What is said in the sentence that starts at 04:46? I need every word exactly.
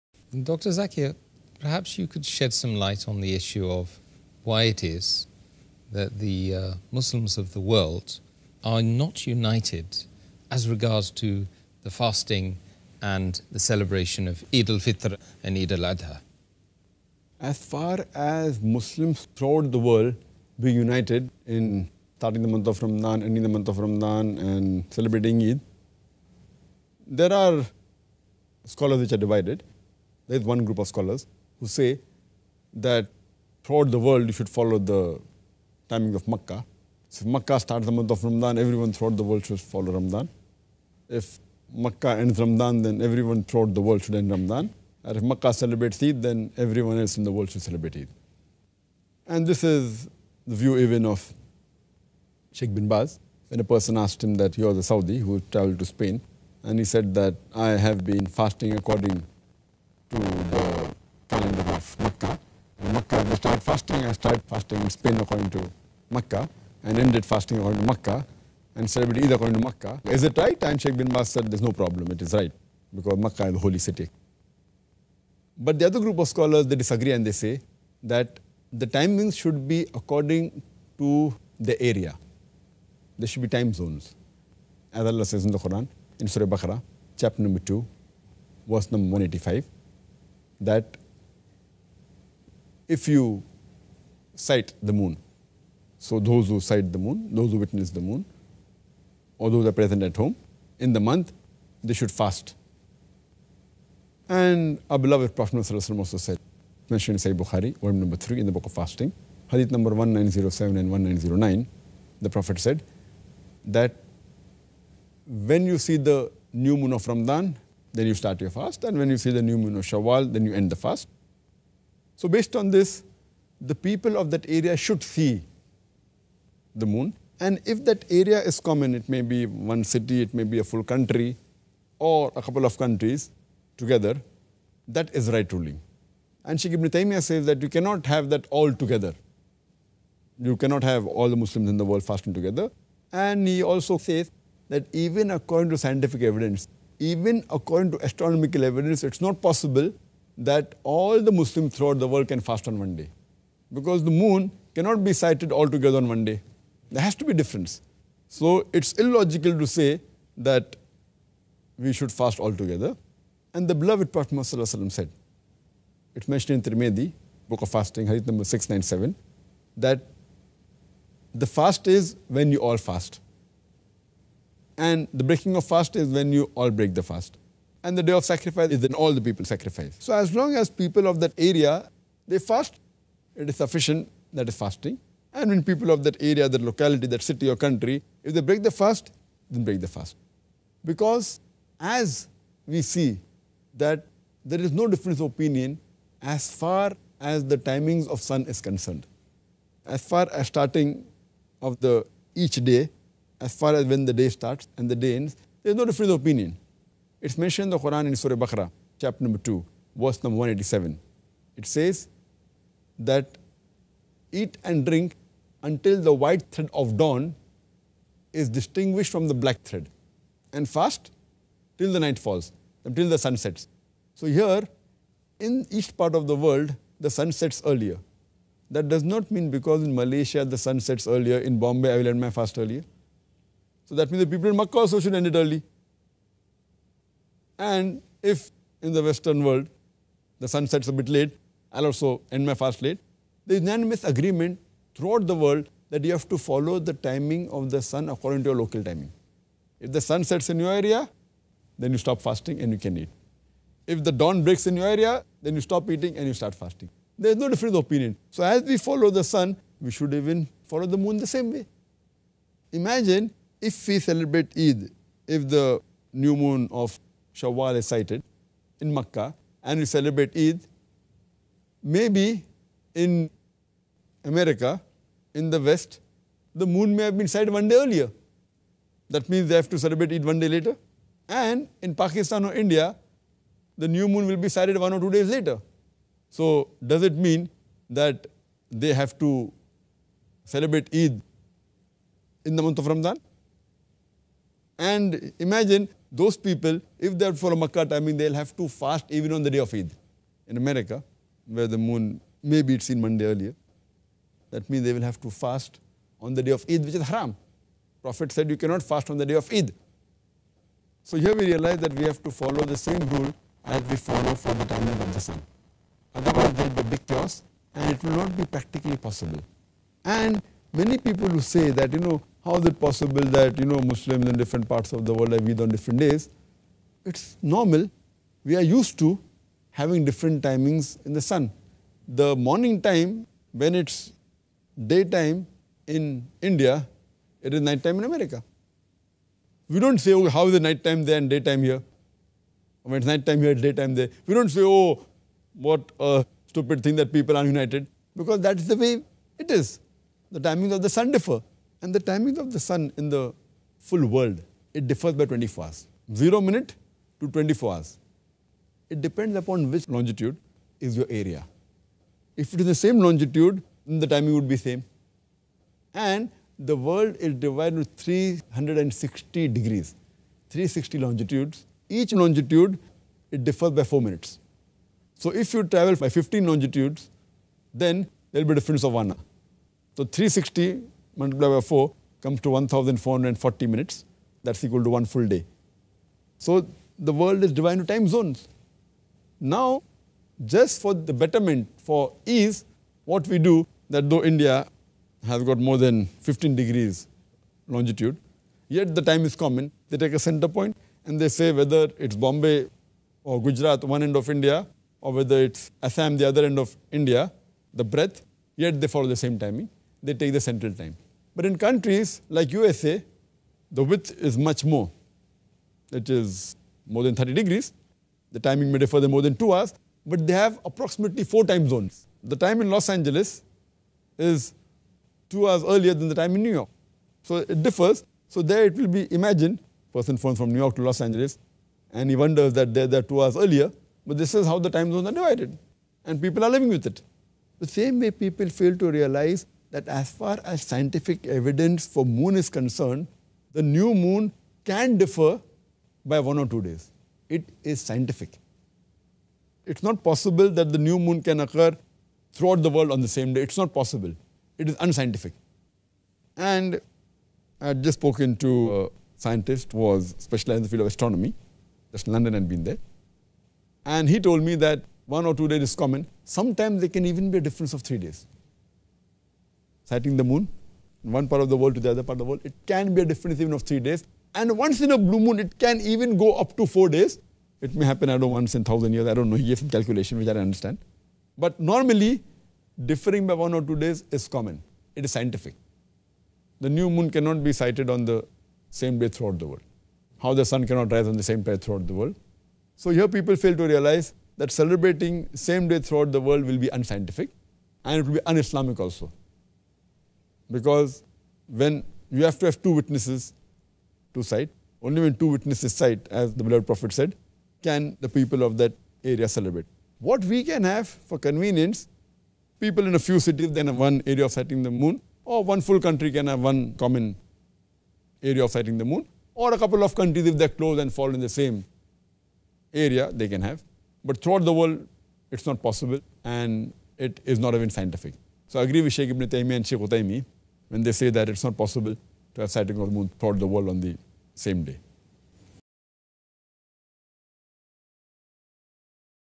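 So does it mean that they have to celebrate Eid in the month of Ramadan?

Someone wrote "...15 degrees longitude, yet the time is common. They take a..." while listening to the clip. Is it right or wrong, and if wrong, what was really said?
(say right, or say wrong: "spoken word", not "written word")
right.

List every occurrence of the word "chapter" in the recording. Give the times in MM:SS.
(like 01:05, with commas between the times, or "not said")
01:27, 03:28.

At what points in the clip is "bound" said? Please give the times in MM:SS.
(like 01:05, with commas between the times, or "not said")
not said.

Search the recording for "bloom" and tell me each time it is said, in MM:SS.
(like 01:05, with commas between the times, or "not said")
not said.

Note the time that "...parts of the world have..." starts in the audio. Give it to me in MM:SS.
05:24.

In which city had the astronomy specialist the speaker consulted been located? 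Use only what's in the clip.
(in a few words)
London.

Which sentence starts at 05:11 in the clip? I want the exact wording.
So here we realize that we have to follow the same rule as we follow for the timing of the sun.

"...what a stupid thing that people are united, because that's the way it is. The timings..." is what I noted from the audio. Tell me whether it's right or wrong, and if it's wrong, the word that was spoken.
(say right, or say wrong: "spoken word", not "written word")
right.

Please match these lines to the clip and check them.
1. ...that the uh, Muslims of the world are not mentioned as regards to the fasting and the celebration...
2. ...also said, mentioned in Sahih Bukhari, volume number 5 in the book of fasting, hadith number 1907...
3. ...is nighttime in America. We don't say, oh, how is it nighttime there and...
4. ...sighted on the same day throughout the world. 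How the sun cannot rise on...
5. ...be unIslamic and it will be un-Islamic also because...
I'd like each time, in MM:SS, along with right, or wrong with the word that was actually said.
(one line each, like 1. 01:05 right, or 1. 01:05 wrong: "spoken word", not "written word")
1. 00:05 wrong: "united", not "mentioned"
2. 01:45 wrong: "3", not "5"
3. 05:37 right
4. 08:07 right
5. 08:16 wrong: "unscientific", not "unIslamic".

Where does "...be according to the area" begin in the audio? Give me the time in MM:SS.
01:19.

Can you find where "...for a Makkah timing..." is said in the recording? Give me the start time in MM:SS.
04:57.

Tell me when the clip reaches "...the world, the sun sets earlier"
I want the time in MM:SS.
03:46.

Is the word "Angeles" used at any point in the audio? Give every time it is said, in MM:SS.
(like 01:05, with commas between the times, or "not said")
07:02, 07:11.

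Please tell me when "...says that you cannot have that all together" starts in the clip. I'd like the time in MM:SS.
02:17.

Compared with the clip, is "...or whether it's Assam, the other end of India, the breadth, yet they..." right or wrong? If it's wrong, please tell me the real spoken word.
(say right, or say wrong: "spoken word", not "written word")
right.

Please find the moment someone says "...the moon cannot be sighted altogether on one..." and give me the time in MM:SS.
02:34.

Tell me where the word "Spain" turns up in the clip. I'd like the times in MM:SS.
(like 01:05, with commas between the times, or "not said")
00:55, 01:04.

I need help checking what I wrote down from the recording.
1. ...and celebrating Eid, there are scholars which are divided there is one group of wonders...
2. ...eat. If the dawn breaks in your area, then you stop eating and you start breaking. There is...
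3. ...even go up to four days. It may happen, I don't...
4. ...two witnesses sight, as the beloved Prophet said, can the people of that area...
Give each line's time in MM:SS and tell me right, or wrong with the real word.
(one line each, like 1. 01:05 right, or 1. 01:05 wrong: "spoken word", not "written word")
1. 00:24 wrong: "scholars", not "wonders"
2. 04:12 wrong: "fasting", not "breaking"
3. 07:55 right
4. 08:25 right.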